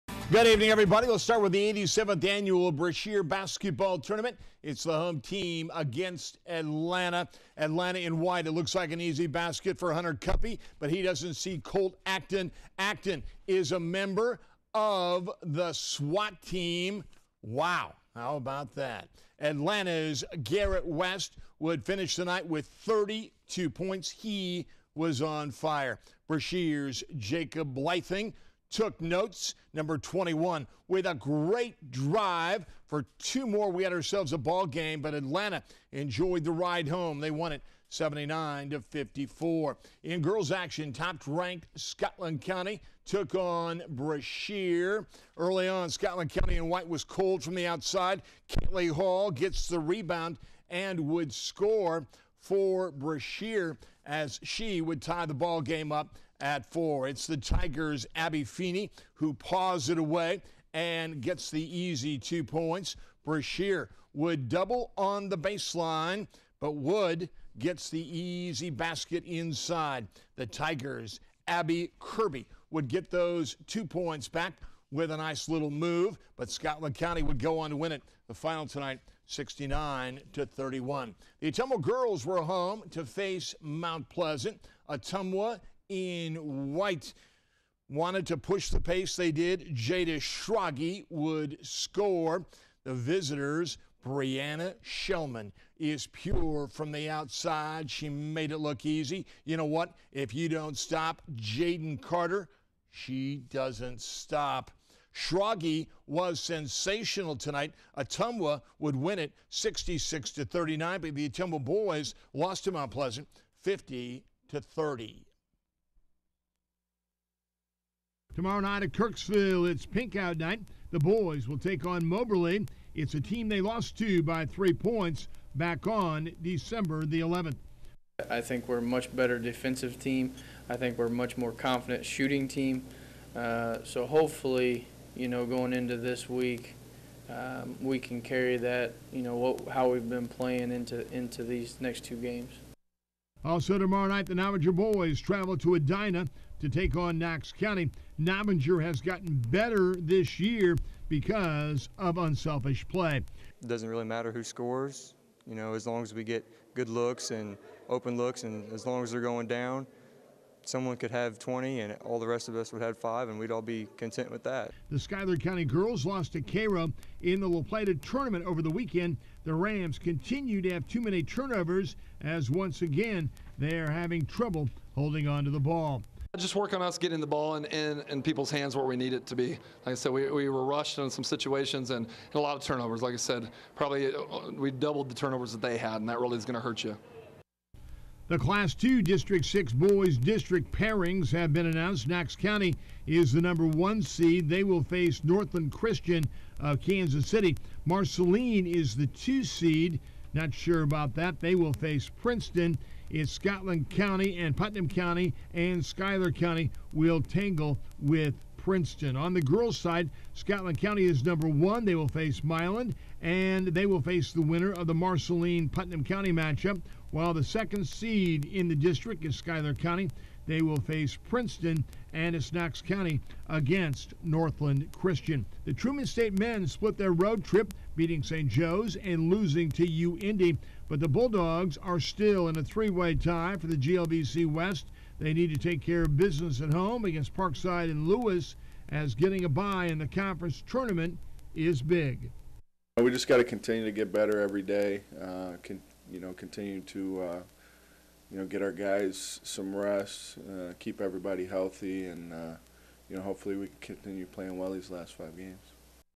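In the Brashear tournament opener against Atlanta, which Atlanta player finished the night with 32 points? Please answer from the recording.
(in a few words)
Garrett West.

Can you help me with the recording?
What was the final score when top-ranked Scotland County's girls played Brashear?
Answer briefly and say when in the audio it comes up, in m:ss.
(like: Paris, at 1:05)
69 to 31, at 1:19.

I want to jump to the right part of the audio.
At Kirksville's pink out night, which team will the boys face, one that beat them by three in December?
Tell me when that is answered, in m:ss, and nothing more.
2:02.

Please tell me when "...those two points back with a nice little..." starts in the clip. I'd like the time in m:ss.
1:13.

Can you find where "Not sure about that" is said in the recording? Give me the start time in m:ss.
3:20.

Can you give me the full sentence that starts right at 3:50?
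But the Bulldogs are still in a three way tie for the GLVC West.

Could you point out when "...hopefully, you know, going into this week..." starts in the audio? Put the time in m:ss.
2:14.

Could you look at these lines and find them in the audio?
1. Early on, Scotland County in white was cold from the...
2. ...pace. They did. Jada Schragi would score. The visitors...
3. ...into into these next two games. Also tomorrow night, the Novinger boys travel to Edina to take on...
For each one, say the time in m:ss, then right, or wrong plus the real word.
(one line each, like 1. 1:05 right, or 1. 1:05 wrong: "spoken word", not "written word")
1. 0:45 right
2. 1:28 right
3. 2:20 right.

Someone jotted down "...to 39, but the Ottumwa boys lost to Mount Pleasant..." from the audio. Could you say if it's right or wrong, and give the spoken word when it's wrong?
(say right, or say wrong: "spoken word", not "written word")
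right.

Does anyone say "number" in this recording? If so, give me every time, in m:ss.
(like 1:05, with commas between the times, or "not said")
0:29, 3:13, 3:31.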